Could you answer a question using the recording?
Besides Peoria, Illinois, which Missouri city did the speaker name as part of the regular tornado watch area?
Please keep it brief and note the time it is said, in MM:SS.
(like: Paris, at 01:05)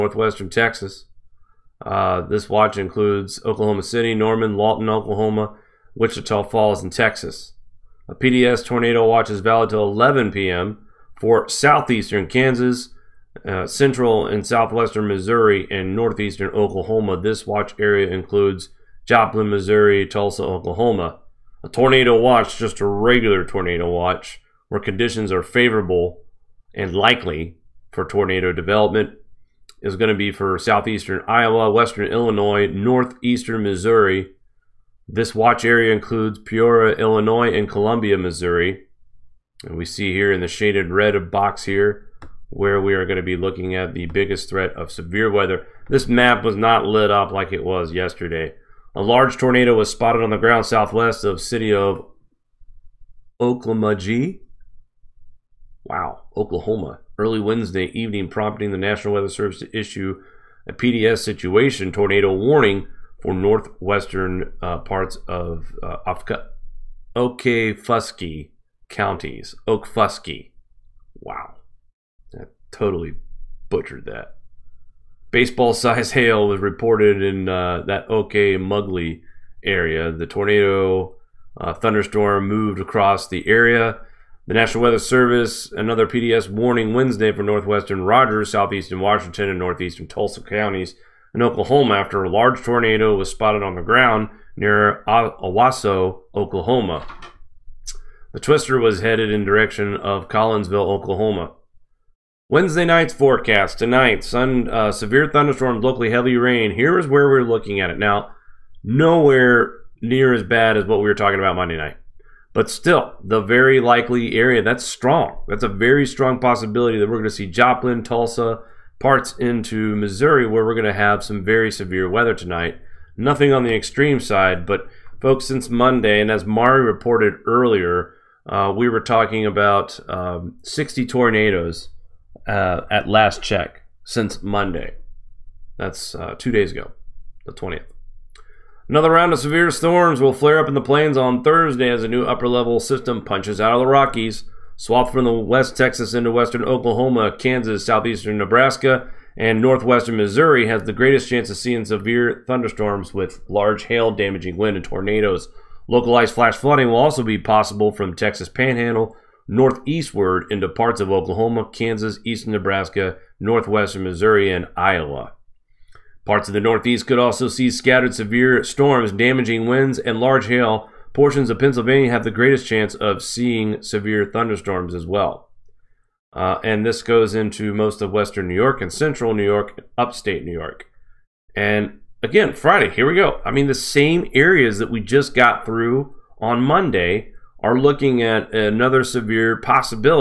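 Columbia, Missouri, at 00:37.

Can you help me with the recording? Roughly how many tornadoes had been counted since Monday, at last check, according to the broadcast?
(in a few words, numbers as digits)
60.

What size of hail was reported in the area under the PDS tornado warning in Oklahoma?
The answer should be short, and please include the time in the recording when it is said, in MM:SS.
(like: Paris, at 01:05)
Baseball sized, at 01:15.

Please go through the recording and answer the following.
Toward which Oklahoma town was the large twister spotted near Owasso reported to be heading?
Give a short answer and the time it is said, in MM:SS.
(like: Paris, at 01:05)
Collinsville, at 01:40.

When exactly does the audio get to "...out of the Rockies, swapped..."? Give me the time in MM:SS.
02:23.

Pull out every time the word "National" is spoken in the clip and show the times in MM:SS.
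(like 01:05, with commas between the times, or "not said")
00:58, 01:24.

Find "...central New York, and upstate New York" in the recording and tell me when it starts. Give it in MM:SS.
02:58.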